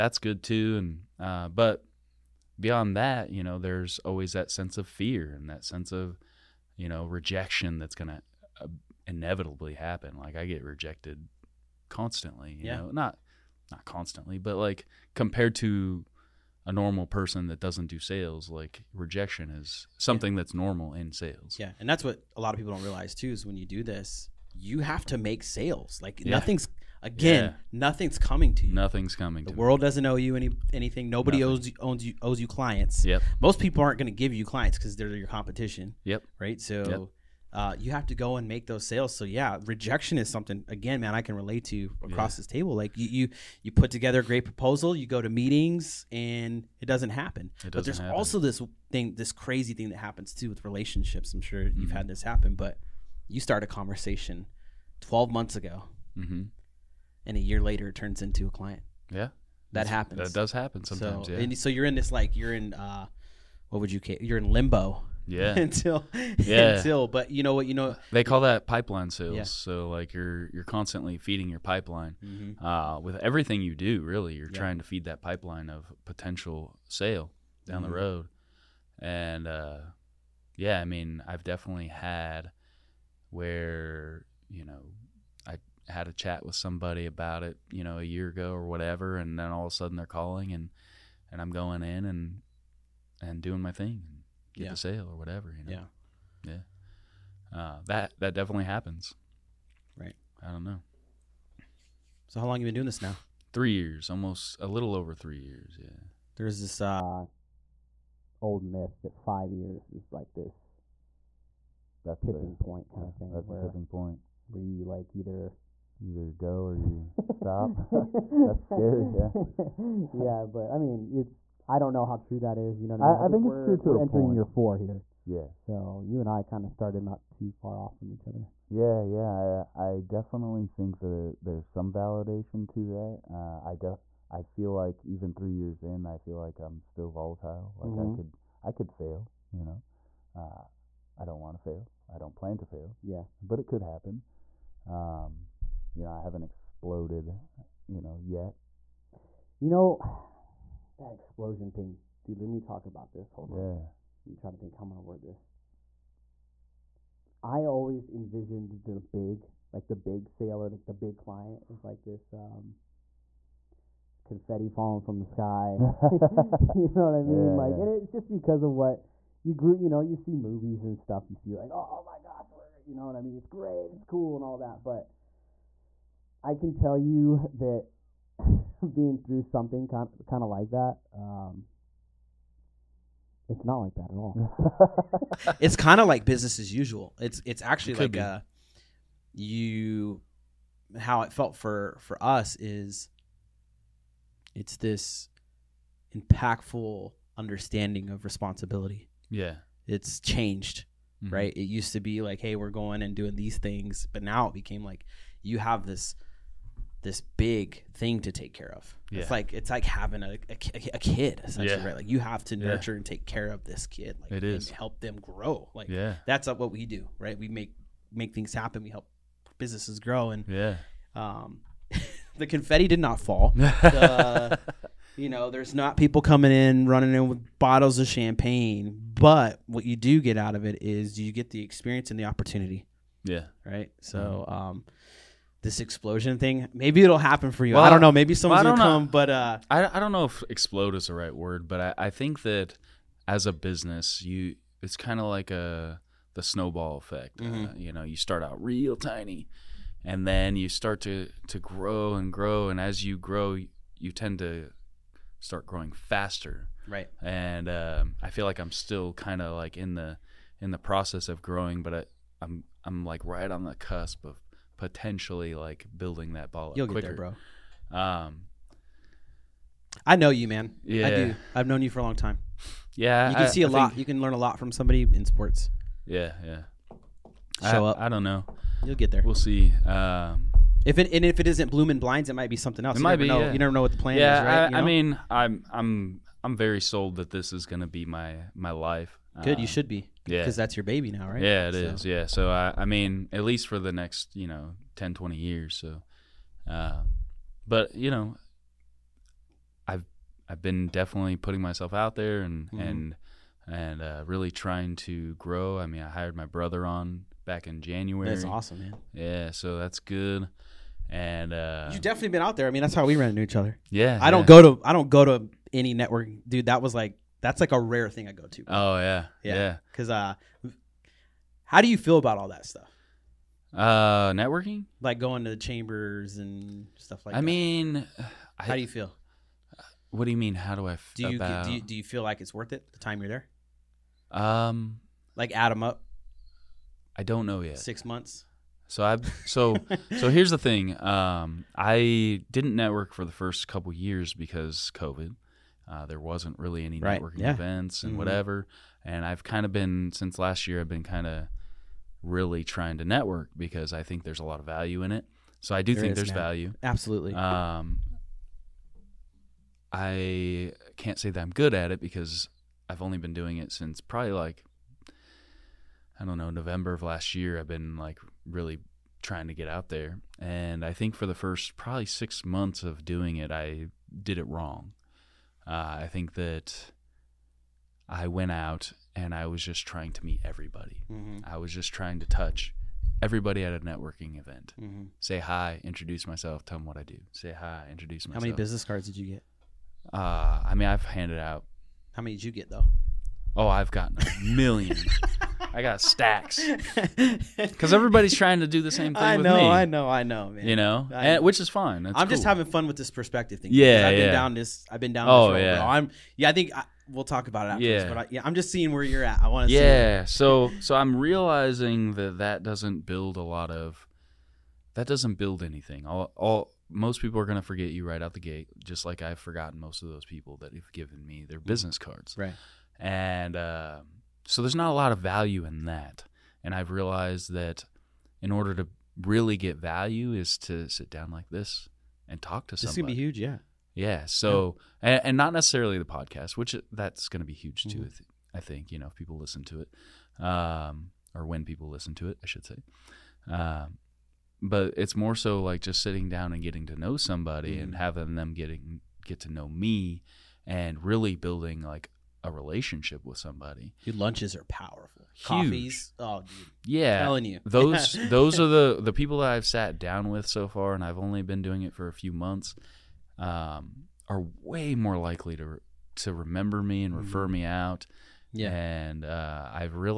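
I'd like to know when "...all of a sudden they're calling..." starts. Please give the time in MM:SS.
01:29.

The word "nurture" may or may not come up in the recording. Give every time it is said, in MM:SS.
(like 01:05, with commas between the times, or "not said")
03:32.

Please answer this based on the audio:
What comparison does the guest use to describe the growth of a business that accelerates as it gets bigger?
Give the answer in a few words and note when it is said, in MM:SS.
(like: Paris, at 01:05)
snowball effect, at 04:06.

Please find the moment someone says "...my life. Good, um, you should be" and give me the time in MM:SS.
04:48.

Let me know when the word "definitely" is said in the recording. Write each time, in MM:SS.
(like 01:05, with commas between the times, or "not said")
01:21, 01:38, 02:10, 05:00, 05:12.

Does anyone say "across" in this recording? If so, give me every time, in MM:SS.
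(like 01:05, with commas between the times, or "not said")
00:42.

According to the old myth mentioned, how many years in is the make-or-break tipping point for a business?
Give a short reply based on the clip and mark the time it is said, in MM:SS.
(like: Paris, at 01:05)
5, at 01:49.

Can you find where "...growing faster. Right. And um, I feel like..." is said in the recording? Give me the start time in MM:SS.
04:15.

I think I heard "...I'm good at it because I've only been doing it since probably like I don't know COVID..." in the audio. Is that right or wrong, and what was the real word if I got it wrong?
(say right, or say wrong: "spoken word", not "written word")
wrong: "November", not "COVID".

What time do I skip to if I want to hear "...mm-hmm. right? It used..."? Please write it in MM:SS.
03:21.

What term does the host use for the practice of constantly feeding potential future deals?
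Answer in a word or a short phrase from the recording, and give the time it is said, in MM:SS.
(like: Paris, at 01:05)
pipeline sales, at 01:08.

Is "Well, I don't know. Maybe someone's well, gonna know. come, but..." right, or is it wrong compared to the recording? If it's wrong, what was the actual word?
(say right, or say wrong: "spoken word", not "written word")
right.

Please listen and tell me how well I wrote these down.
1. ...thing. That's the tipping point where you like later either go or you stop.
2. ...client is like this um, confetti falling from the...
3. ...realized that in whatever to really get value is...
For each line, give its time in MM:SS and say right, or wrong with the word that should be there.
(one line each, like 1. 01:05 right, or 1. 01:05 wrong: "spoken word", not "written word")
1. 01:53 wrong: "either", not "later"
2. 02:41 right
3. 07:06 wrong: "order", not "whatever".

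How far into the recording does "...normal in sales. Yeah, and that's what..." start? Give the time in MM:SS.
00:20.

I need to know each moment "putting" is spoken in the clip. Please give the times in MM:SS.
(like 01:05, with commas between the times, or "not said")
05:01.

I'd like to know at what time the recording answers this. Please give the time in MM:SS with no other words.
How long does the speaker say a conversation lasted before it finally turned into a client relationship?
00:54.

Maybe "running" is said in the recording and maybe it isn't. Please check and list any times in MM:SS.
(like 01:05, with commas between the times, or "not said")
03:46.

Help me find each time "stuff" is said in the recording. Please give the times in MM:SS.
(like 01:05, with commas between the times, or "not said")
02:50, 05:22, 05:26.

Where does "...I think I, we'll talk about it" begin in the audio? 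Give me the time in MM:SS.
06:46.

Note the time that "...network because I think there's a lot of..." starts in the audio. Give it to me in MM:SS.
05:53.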